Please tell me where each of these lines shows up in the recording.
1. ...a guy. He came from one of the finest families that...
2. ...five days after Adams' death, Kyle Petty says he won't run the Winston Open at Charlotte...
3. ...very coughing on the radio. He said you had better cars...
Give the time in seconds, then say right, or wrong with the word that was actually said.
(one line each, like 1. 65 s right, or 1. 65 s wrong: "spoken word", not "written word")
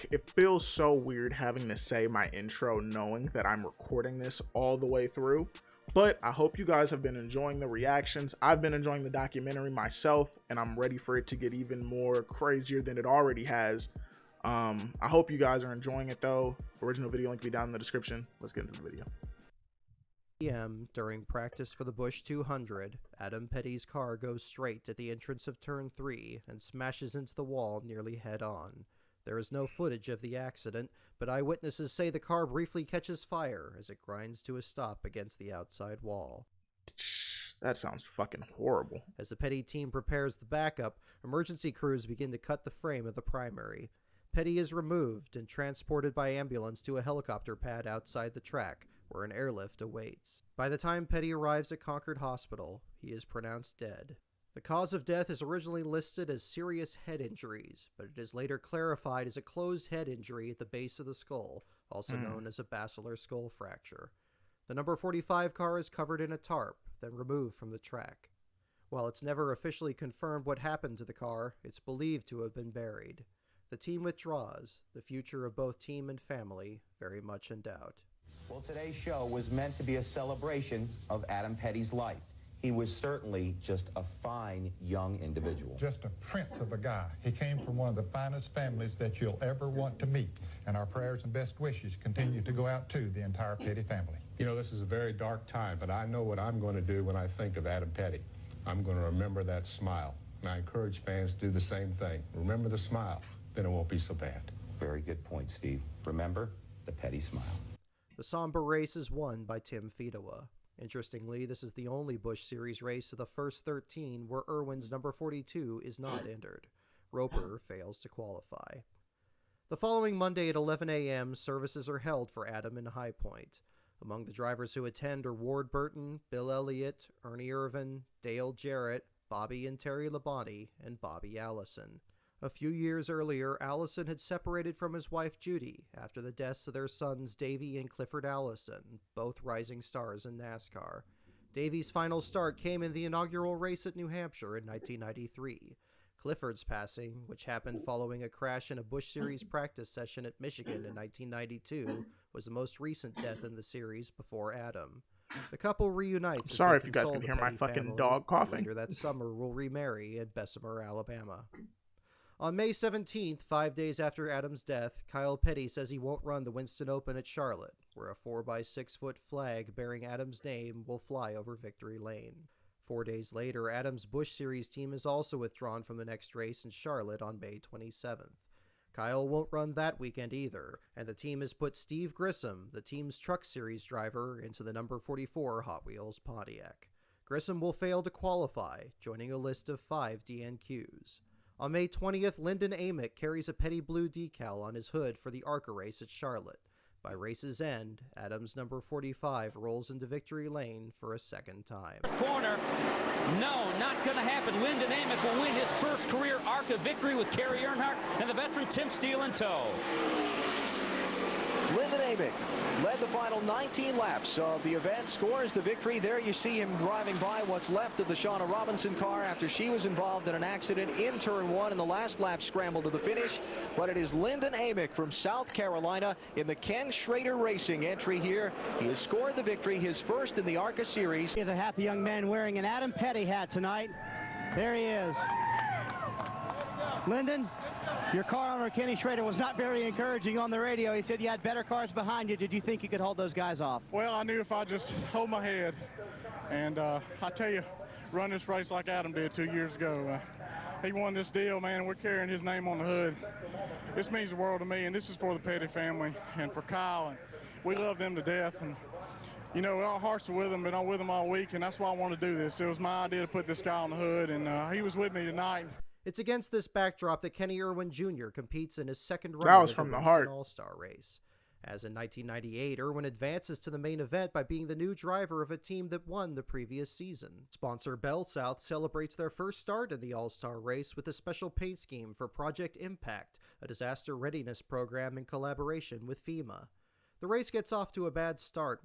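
1. 86 s right
2. 163 s right
3. 239 s wrong: "encouraging", not "coughing".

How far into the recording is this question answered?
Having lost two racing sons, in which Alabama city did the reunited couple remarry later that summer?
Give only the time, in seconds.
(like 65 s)
160 s.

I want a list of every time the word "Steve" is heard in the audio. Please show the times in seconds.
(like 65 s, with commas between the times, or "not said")
105 s, 181 s.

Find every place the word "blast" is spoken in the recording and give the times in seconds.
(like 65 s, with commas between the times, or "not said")
not said.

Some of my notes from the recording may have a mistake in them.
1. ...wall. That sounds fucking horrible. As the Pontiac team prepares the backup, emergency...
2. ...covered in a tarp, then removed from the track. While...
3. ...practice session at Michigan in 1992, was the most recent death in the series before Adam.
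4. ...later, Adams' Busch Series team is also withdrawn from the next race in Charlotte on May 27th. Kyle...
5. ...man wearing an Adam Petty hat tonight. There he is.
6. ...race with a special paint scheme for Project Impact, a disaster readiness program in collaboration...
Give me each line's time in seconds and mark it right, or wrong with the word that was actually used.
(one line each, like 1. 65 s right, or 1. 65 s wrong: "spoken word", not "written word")
1. 36 s wrong: "Petty", not "Pontiac"
2. 65 s right
3. 149 s right
4. 173 s right
5. 232 s right
6. 280 s right.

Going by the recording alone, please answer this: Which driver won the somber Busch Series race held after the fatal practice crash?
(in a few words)
Tim Fedewa.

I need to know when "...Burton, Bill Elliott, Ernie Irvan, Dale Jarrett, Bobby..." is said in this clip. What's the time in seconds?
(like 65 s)
125 s.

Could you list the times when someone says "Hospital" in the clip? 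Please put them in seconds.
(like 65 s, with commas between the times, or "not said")
52 s.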